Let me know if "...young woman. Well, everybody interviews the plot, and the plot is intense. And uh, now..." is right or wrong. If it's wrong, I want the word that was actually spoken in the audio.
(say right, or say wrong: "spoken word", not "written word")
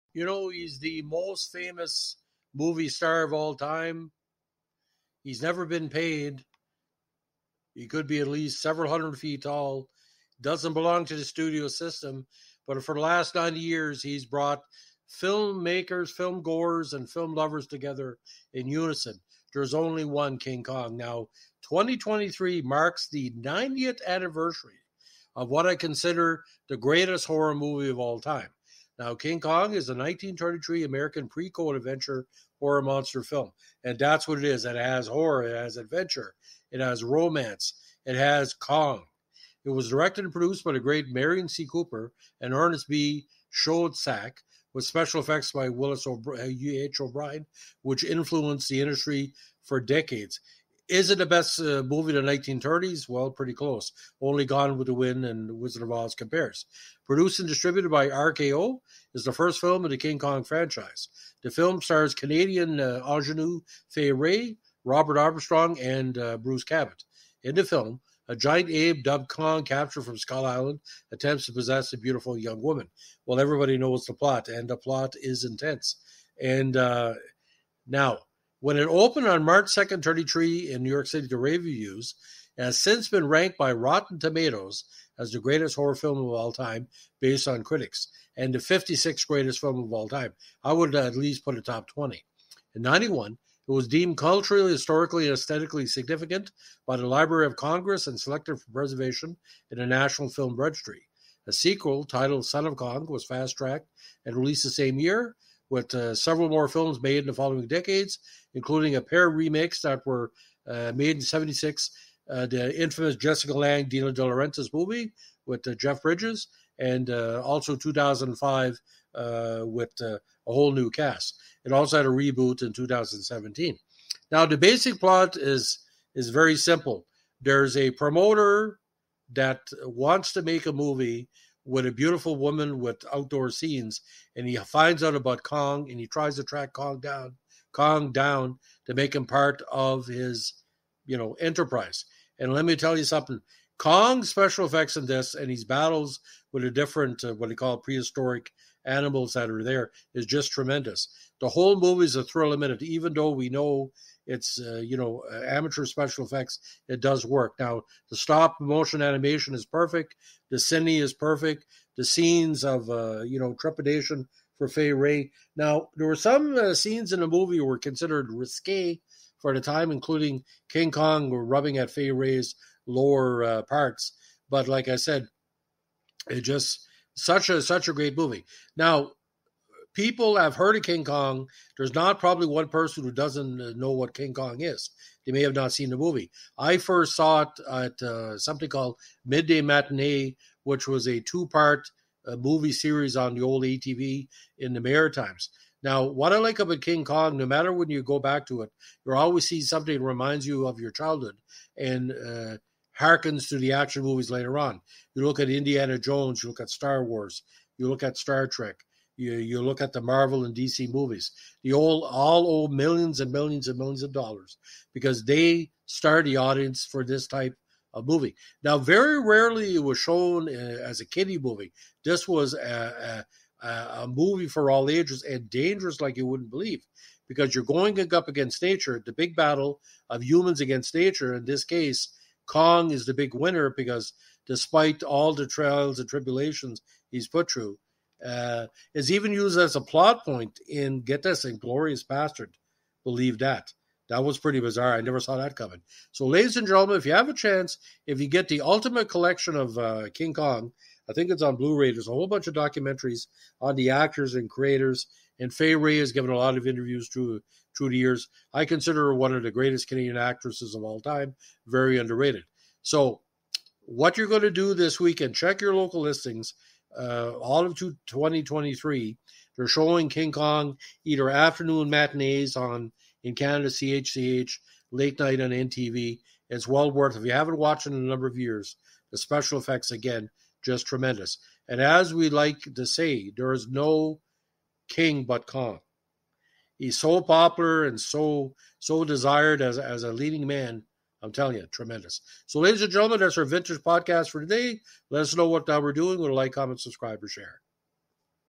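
wrong: "knows", not "interviews".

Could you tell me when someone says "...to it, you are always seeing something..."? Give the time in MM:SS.
03:18.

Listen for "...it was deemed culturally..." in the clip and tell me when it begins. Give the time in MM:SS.
01:33.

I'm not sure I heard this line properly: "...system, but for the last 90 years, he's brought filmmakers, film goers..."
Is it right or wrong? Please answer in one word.
right.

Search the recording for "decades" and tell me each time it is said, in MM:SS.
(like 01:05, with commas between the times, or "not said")
00:49, 01:47.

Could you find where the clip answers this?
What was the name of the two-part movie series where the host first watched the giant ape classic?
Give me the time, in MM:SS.
03:09.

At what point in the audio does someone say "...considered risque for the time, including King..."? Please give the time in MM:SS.
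02:47.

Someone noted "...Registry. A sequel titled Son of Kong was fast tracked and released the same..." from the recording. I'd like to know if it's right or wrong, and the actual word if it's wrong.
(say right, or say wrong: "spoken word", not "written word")
right.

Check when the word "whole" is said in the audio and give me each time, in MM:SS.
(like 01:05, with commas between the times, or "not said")
02:00, 02:31, 04:12.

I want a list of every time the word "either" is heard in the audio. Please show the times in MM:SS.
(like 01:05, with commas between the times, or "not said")
04:31.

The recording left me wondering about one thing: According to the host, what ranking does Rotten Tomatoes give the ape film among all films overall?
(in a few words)
56th.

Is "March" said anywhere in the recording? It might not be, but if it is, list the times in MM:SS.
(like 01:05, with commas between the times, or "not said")
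01:19.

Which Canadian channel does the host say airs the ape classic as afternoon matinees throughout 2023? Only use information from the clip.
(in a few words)
CHCH.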